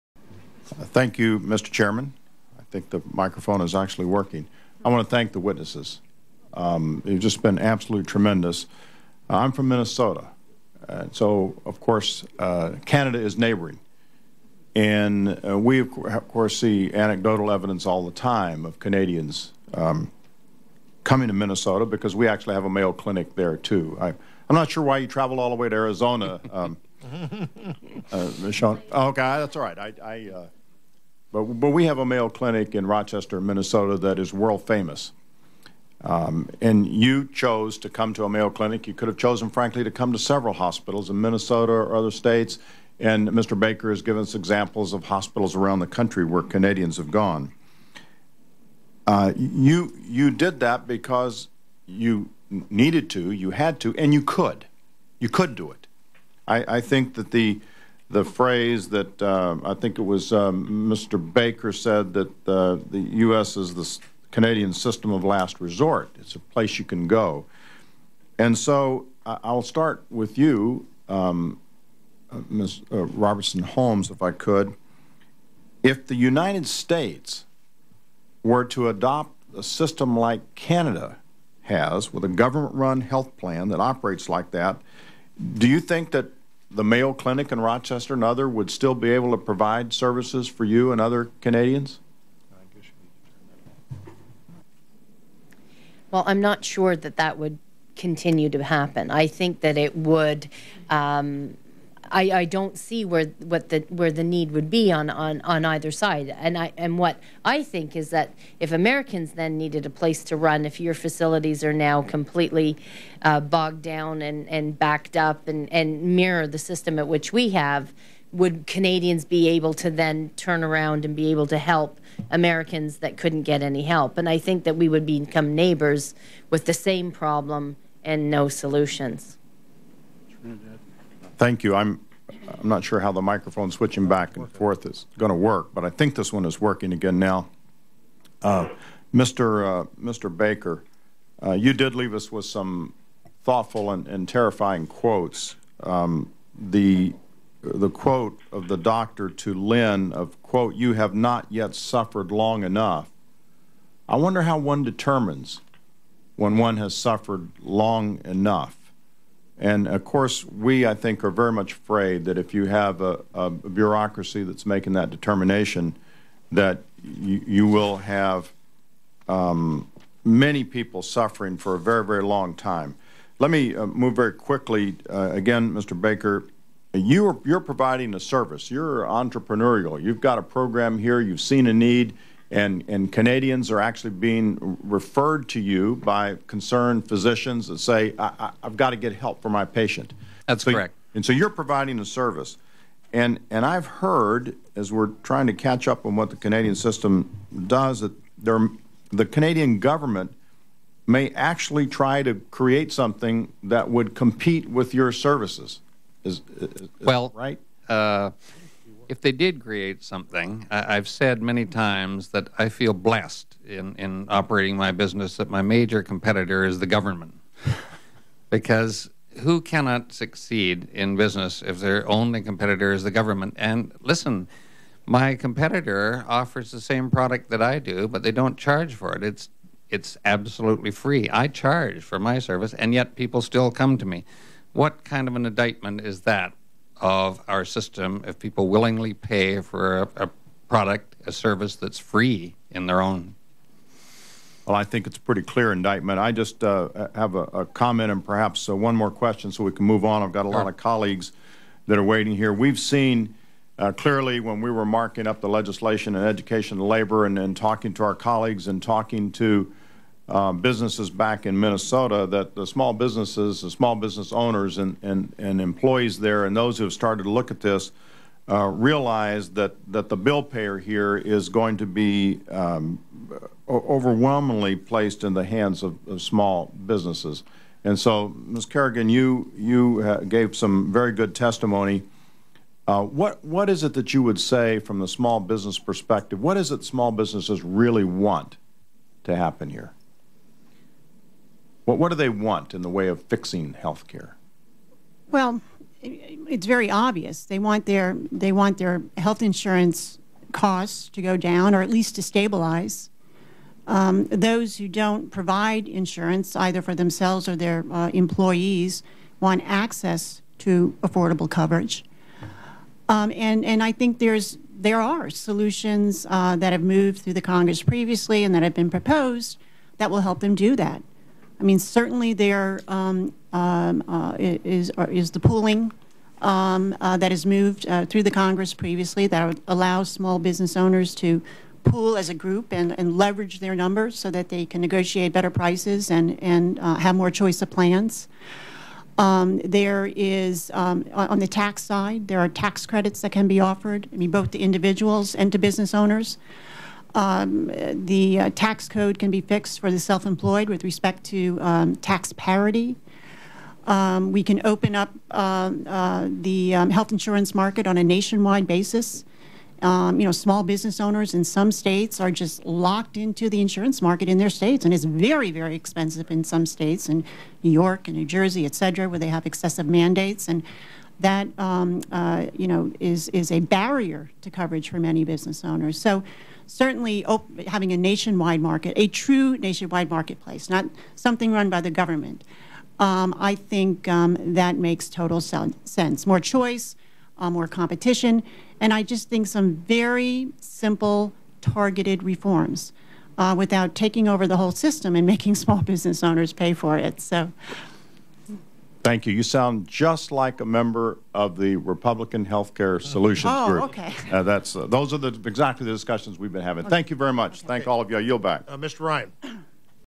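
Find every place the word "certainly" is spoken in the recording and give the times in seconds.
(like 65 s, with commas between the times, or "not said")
321 s, 376 s.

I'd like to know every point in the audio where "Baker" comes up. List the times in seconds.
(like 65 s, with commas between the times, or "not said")
43 s, 61 s, 140 s, 175 s.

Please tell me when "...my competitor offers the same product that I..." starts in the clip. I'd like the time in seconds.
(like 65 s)
225 s.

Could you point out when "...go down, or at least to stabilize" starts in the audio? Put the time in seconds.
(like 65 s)
301 s.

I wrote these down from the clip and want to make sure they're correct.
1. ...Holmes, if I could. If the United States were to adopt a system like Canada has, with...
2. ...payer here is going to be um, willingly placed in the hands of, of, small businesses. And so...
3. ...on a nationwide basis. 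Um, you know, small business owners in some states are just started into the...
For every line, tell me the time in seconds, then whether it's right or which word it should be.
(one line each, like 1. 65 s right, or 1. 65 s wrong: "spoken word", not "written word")
1. 73 s right
2. 270 s wrong: "overwhelmingly", not "willingly"
3. 357 s wrong: "locked", not "started".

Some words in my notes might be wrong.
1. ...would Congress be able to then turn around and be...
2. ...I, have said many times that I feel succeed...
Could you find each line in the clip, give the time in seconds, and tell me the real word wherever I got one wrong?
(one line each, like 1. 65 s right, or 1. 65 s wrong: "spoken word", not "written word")
1. 118 s wrong: "Canadians", not "Congress"
2. 210 s wrong: "blessed", not "succeed".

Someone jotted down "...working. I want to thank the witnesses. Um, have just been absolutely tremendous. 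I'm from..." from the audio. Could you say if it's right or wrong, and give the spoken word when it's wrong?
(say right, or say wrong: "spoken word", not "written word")
right.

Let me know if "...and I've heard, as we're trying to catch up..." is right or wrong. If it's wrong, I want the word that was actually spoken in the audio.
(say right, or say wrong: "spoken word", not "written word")
right.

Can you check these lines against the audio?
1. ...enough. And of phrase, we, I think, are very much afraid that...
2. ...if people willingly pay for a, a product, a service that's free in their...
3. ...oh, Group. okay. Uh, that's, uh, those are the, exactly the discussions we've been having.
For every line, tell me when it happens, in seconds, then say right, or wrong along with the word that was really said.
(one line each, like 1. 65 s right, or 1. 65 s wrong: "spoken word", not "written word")
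1. 158 s wrong: "course", not "phrase"
2. 238 s right
3. 403 s right.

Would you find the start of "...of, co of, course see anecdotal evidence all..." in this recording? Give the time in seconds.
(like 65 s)
15 s.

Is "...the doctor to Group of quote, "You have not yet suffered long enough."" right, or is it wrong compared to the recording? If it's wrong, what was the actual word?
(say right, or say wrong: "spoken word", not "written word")
wrong: "Lynn", not "Group".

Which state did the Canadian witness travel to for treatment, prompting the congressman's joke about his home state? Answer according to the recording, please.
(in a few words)
Arizona.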